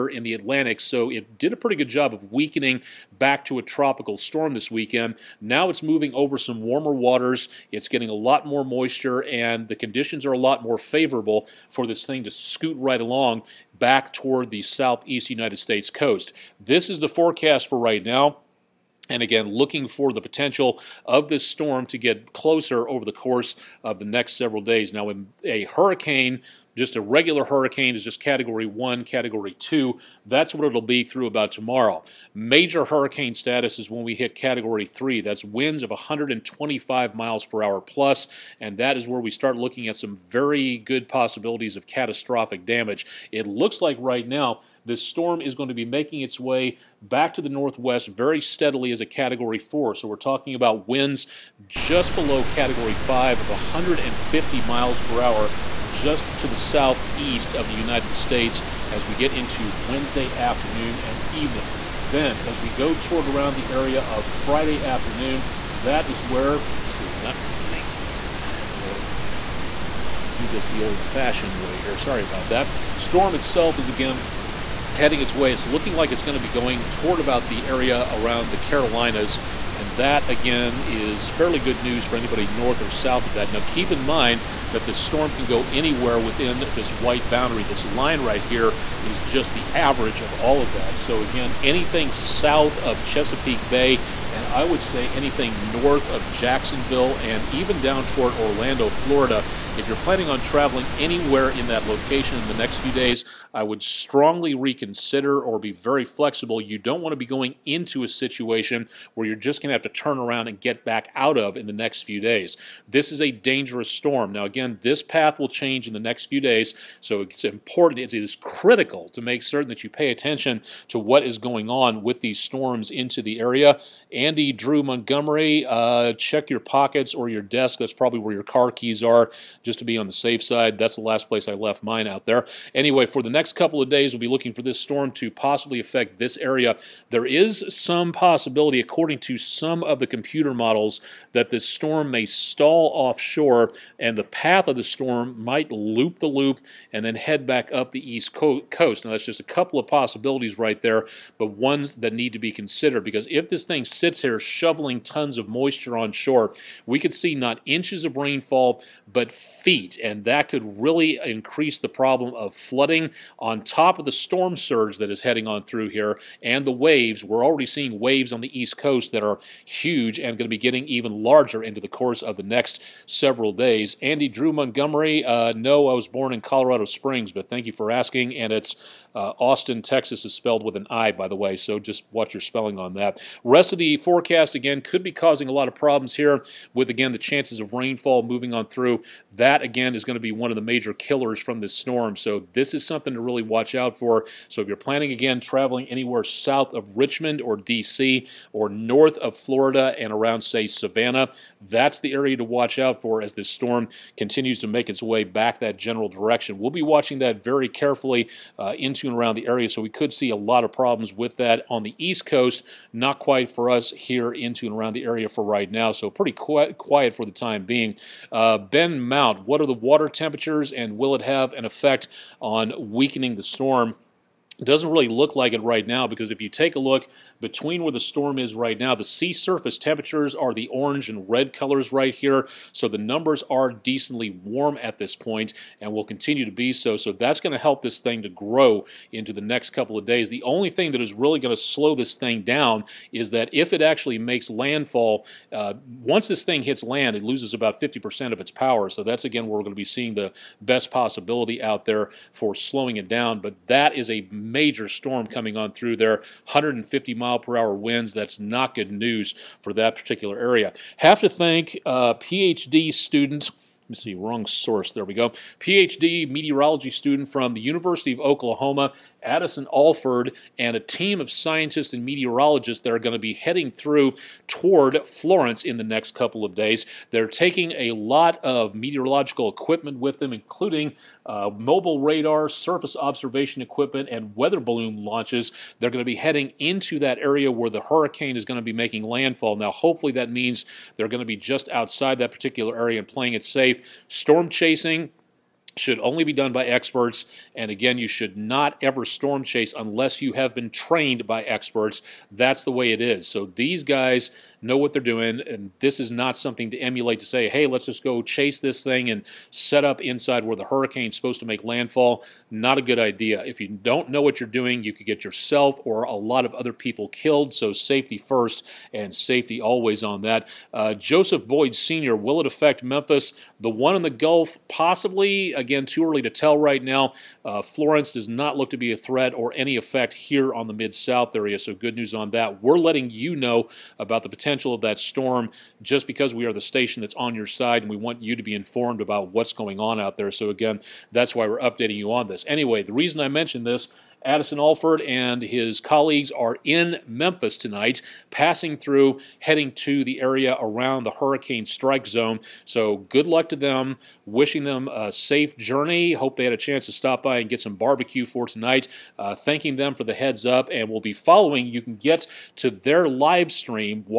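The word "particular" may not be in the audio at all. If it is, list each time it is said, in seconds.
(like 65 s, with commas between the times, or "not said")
259 s, 292 s.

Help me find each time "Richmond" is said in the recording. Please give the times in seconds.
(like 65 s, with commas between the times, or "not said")
196 s.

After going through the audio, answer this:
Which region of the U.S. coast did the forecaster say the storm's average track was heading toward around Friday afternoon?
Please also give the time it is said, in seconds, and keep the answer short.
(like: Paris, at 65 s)
the Carolinas, at 78 s.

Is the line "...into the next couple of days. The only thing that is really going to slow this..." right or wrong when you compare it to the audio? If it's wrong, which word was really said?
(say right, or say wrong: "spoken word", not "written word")
right.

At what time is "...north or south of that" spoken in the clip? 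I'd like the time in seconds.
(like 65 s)
82 s.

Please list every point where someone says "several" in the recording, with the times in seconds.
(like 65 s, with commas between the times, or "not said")
24 s, 173 s.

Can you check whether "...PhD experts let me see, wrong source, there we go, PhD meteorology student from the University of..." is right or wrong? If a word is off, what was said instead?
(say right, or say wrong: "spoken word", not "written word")
wrong: "students", not "experts".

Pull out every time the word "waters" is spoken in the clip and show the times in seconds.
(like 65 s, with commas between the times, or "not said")
6 s, 219 s.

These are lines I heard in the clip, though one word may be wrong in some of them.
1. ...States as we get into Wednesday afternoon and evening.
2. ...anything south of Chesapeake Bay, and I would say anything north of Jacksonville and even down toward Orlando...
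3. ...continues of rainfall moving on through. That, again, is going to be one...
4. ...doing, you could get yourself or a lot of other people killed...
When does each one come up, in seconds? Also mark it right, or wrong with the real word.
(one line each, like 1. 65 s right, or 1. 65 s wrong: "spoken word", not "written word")
1. 58 s right
2. 91 s right
3. 187 s wrong: "chances", not "continues"
4. 314 s right.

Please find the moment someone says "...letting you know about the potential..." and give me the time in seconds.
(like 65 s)
332 s.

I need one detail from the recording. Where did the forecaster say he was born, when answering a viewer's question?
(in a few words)
Colorado Springs.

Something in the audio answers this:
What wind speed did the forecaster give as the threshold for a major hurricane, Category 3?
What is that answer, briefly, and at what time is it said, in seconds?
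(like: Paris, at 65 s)
125 miles per hour, at 35 s.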